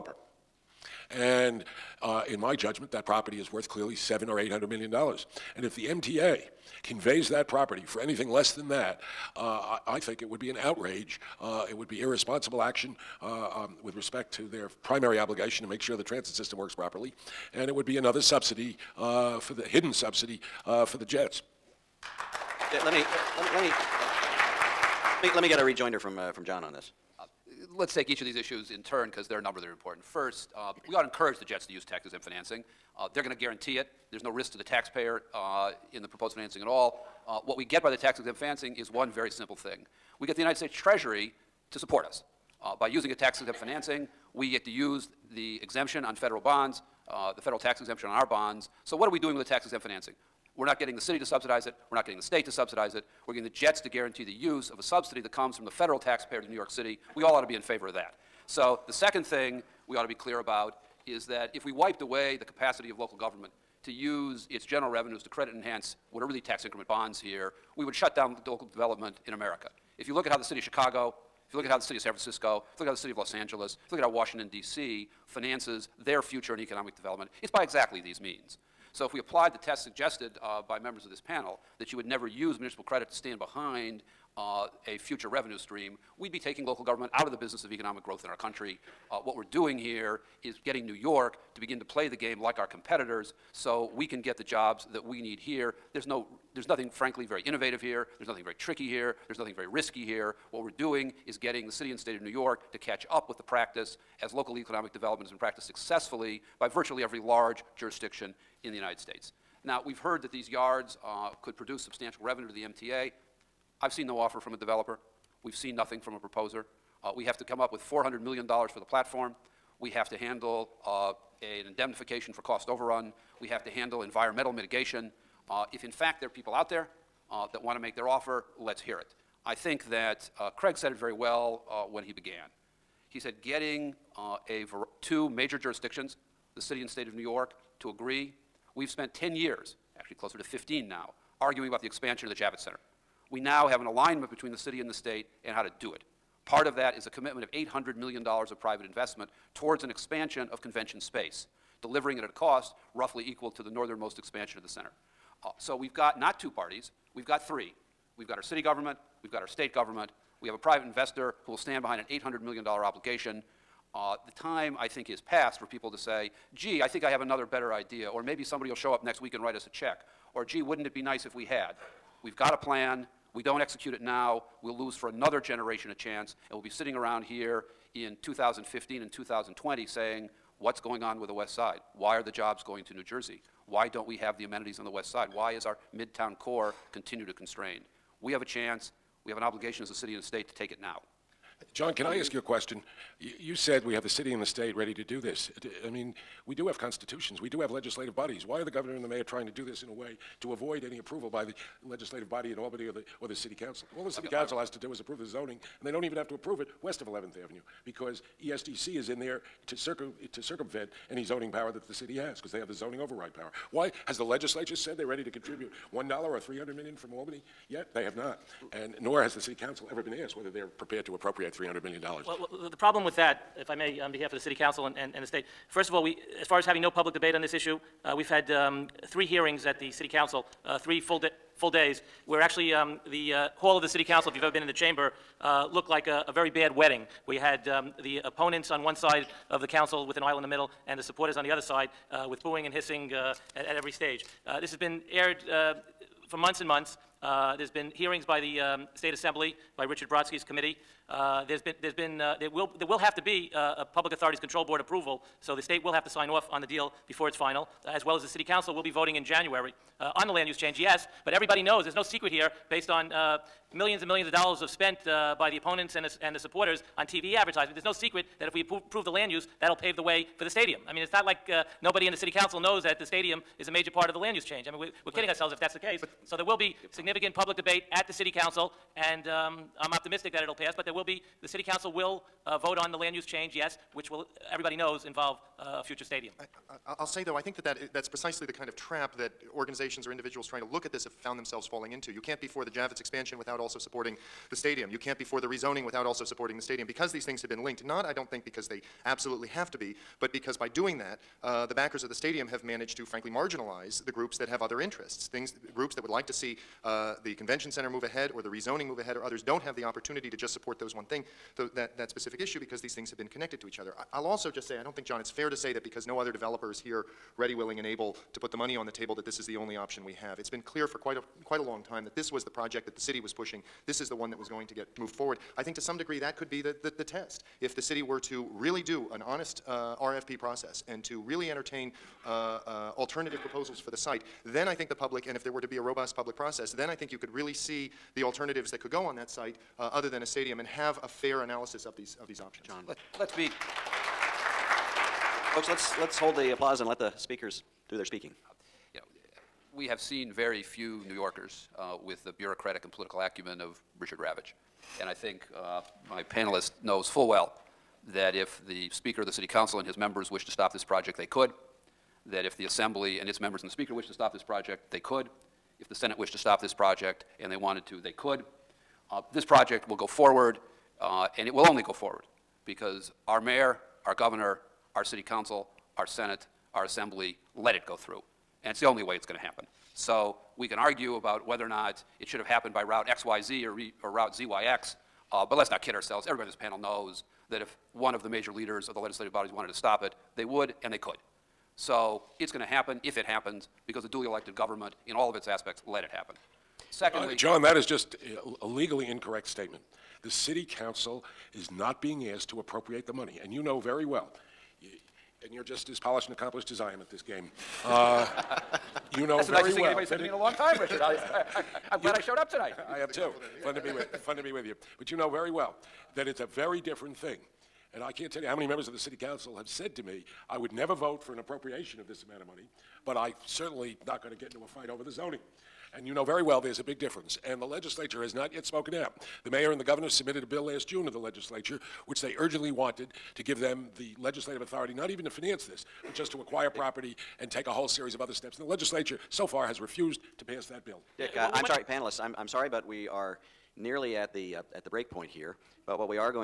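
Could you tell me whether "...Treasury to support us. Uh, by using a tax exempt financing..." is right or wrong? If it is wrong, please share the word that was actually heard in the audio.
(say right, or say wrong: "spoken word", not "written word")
right.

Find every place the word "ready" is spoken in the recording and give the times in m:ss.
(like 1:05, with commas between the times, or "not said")
3:14, 3:35, 5:17.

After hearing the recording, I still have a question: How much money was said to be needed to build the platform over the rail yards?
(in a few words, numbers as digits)
$400 million.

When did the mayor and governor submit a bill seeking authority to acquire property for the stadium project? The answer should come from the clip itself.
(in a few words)
Last June.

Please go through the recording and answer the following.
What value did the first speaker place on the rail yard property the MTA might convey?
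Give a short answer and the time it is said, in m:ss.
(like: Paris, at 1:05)
700 or 800 million dollars, at 0:03.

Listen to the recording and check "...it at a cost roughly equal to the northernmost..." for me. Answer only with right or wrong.
right.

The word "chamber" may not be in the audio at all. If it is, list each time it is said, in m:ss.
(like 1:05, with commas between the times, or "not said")
3:54.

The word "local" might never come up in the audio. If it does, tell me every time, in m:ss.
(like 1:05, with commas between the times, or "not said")
1:02, 1:08, 1:26, 1:44.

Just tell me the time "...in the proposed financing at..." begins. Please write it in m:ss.
0:35.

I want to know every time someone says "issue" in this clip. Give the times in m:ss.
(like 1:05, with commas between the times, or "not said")
0:28, 3:47, 5:12.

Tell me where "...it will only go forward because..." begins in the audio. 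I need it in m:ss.
6:11.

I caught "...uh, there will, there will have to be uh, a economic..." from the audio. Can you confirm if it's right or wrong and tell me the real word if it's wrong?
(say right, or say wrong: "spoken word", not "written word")
wrong: "public", not "economic".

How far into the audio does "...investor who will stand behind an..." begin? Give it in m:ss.
2:40.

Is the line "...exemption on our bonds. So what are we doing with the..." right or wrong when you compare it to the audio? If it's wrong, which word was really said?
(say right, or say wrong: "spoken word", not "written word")
right.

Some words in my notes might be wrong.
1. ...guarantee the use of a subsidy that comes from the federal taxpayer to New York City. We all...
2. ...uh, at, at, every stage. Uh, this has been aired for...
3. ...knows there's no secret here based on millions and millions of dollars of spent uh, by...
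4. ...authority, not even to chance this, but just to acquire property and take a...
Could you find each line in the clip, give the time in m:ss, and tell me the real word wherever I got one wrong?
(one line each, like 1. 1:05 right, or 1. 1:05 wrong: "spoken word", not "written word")
1. 0:53 right
2. 4:03 right
3. 4:21 right
4. 7:14 wrong: "finance", not "chance".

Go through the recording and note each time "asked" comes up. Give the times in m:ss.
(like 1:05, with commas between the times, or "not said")
3:40, 6:42.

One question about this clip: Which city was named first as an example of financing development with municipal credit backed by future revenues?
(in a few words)
Chicago.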